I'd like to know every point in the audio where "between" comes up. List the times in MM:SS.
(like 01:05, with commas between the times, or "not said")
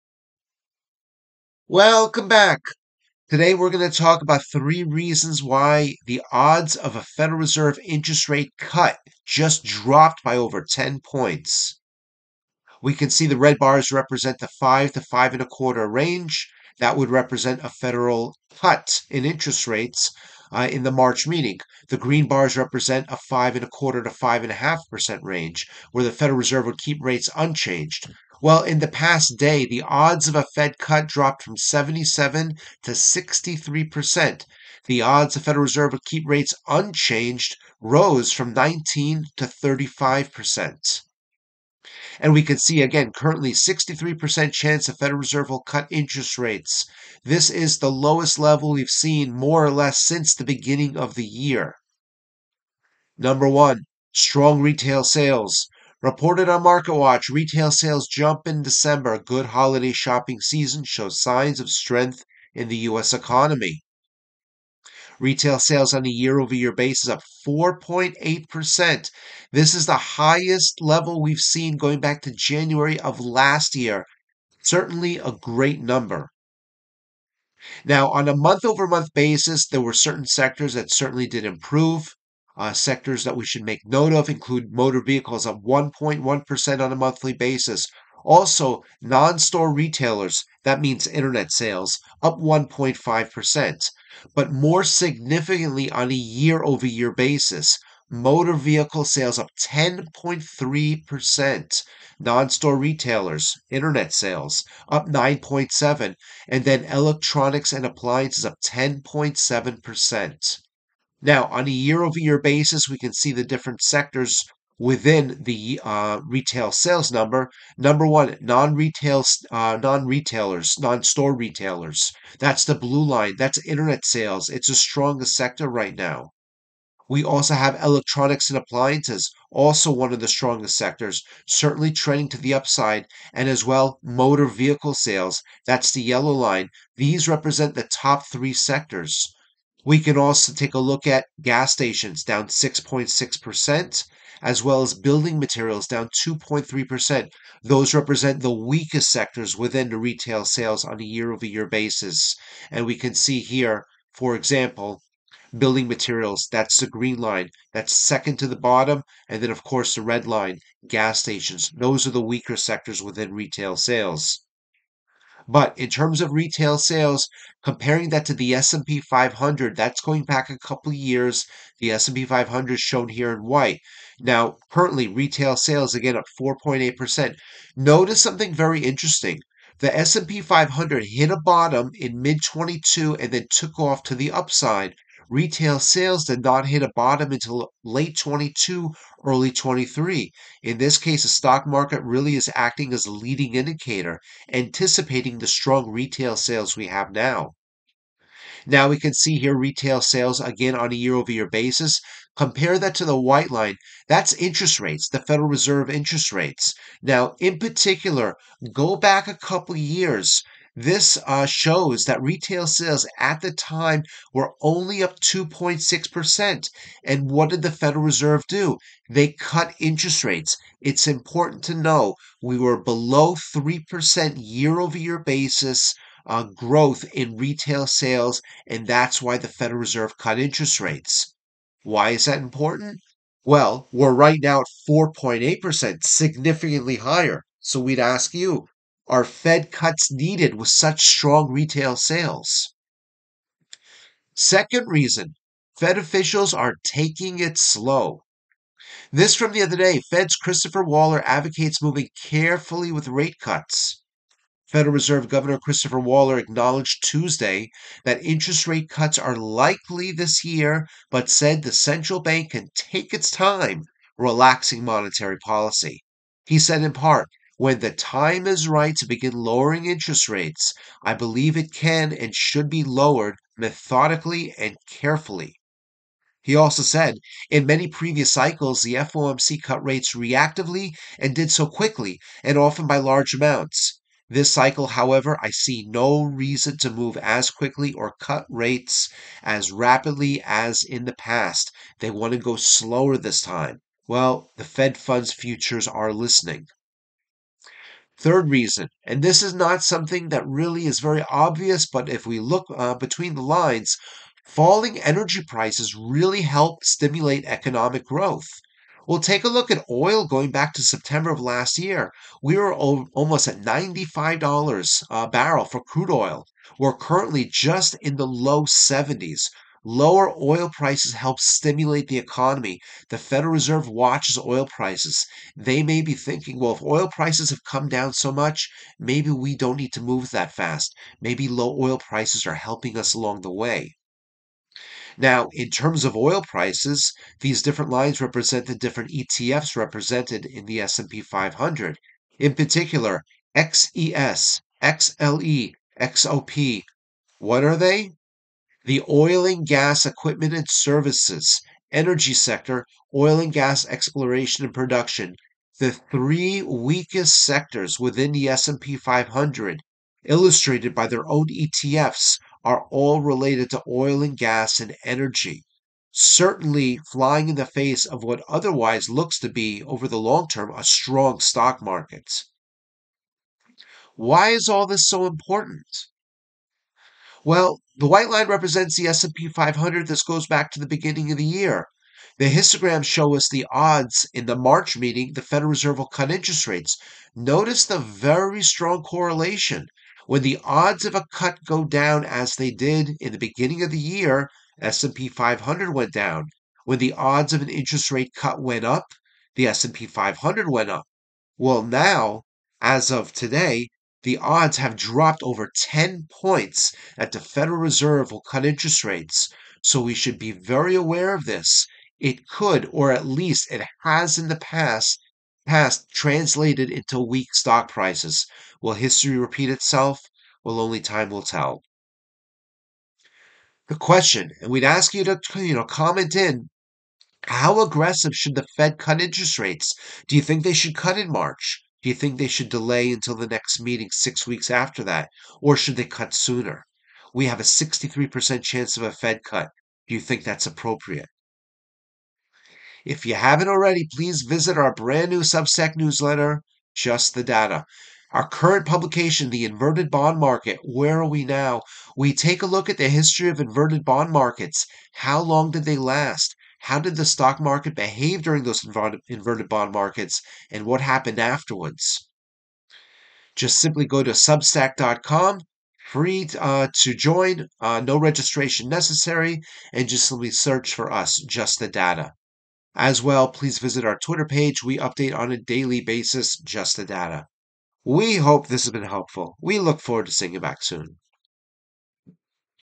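05:02.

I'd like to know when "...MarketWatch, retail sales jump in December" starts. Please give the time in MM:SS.
00:56.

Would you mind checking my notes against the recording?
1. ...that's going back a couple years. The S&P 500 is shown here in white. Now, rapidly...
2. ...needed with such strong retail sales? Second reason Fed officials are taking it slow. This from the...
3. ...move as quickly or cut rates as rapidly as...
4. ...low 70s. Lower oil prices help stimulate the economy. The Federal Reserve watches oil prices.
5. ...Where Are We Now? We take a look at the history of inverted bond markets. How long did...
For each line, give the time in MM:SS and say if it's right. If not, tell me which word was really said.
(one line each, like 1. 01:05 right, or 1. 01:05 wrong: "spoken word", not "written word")
1. 02:49 wrong: "currently", not "rapidly"
2. 04:00 right
3. 04:46 right
4. 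05:18 right
5. 07:30 right.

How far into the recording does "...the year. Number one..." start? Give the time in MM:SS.
00:51.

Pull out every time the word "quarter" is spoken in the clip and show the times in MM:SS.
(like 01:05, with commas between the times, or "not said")
00:15, 00:23.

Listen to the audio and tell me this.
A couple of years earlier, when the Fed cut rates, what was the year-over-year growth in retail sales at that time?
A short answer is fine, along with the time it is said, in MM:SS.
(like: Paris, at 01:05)
2.6%, at 03:35.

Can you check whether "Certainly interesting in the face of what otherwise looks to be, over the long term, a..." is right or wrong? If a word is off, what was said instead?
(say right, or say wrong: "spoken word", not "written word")
wrong: "flying", not "interesting".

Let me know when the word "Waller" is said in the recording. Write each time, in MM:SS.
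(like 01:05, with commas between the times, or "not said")
04:10, 04:15.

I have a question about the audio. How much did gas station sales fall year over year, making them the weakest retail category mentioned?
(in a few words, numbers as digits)
6.6%.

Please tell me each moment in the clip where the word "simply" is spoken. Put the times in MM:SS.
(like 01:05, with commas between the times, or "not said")
07:43, 07:50.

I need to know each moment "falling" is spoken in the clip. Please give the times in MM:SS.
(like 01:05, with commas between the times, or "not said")
05:04.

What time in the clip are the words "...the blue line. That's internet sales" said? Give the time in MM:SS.
02:02.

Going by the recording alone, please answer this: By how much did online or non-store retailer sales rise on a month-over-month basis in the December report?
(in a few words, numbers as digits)
1.5%.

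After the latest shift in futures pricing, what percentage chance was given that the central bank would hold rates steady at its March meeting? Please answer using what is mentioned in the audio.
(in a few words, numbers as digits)
35%.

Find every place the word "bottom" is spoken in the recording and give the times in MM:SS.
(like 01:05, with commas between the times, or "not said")
02:38, 03:01, 03:06.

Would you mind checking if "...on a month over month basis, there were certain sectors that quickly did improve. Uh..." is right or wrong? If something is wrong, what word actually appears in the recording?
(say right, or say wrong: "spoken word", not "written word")
wrong: "certainly", not "quickly".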